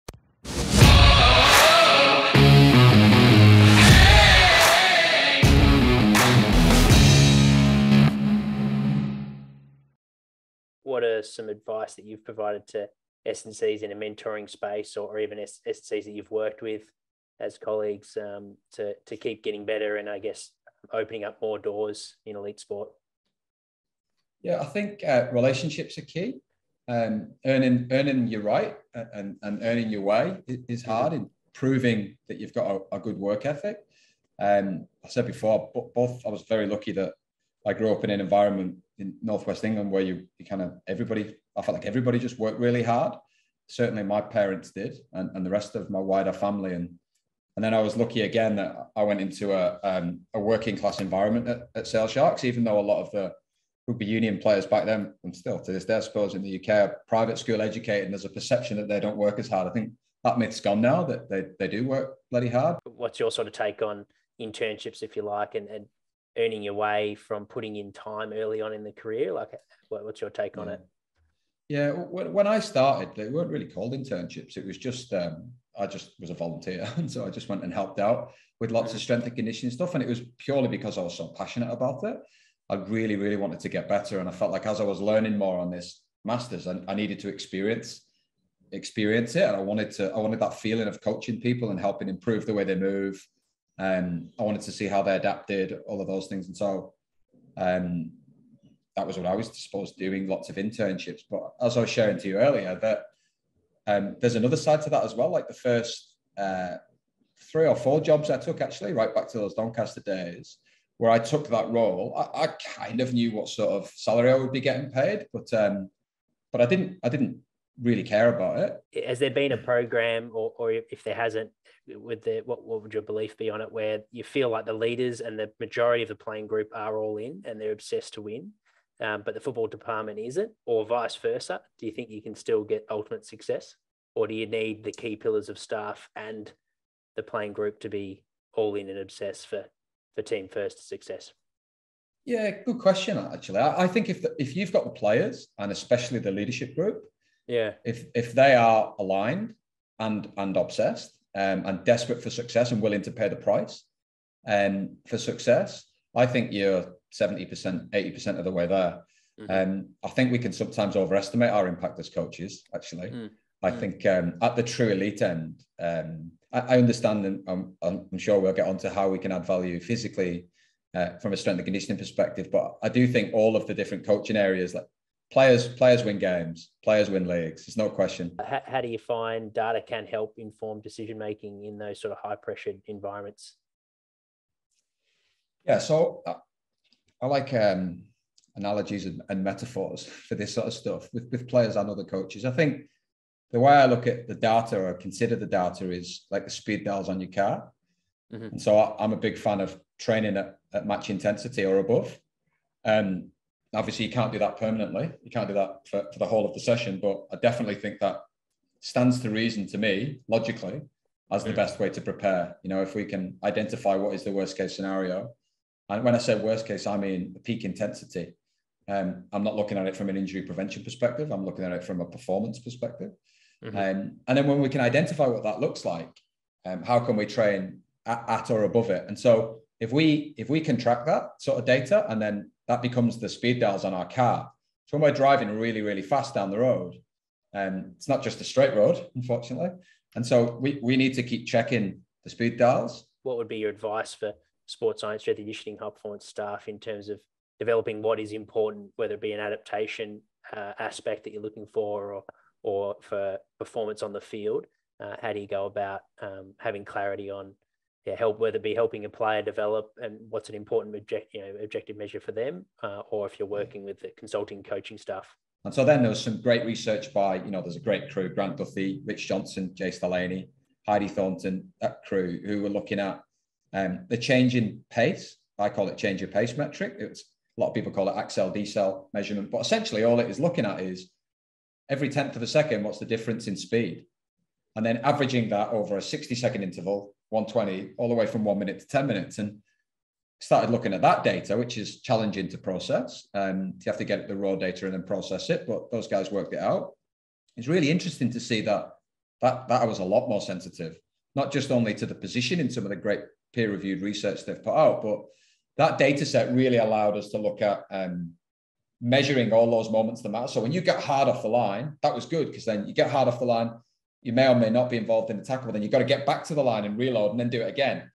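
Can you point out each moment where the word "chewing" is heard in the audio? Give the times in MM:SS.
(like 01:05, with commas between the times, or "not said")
not said.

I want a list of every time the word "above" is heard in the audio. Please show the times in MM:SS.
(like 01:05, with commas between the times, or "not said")
03:21, 03:48.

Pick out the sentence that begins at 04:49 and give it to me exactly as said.
And started looking at that data, which is challenging to process.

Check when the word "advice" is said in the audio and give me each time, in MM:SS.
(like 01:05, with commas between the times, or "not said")
00:11, 04:03.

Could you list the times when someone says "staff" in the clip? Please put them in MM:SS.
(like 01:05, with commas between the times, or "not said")
02:15, 04:06, 04:24.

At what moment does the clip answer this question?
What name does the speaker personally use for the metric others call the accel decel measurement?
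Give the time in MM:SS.
04:35.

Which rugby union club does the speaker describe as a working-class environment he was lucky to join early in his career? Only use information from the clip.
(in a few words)
Sale Sharks.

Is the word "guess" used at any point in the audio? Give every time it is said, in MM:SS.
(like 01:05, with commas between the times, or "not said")
00:20.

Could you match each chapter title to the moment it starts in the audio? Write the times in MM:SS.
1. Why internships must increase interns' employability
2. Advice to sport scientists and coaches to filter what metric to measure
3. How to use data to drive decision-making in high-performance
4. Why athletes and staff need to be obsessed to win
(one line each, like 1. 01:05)
1. 01:02
2. 04:03
3. 02:58
4. 01:58.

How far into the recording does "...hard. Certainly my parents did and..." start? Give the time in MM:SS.
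00:42.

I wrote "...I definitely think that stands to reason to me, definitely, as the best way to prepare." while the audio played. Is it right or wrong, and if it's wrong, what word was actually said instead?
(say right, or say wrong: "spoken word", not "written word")
wrong: "logically", not "definitely".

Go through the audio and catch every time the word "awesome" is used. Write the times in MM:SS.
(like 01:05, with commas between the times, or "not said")
not said.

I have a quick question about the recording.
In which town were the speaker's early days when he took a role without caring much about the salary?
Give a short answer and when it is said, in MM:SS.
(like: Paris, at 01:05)
Doncaster, at 01:49.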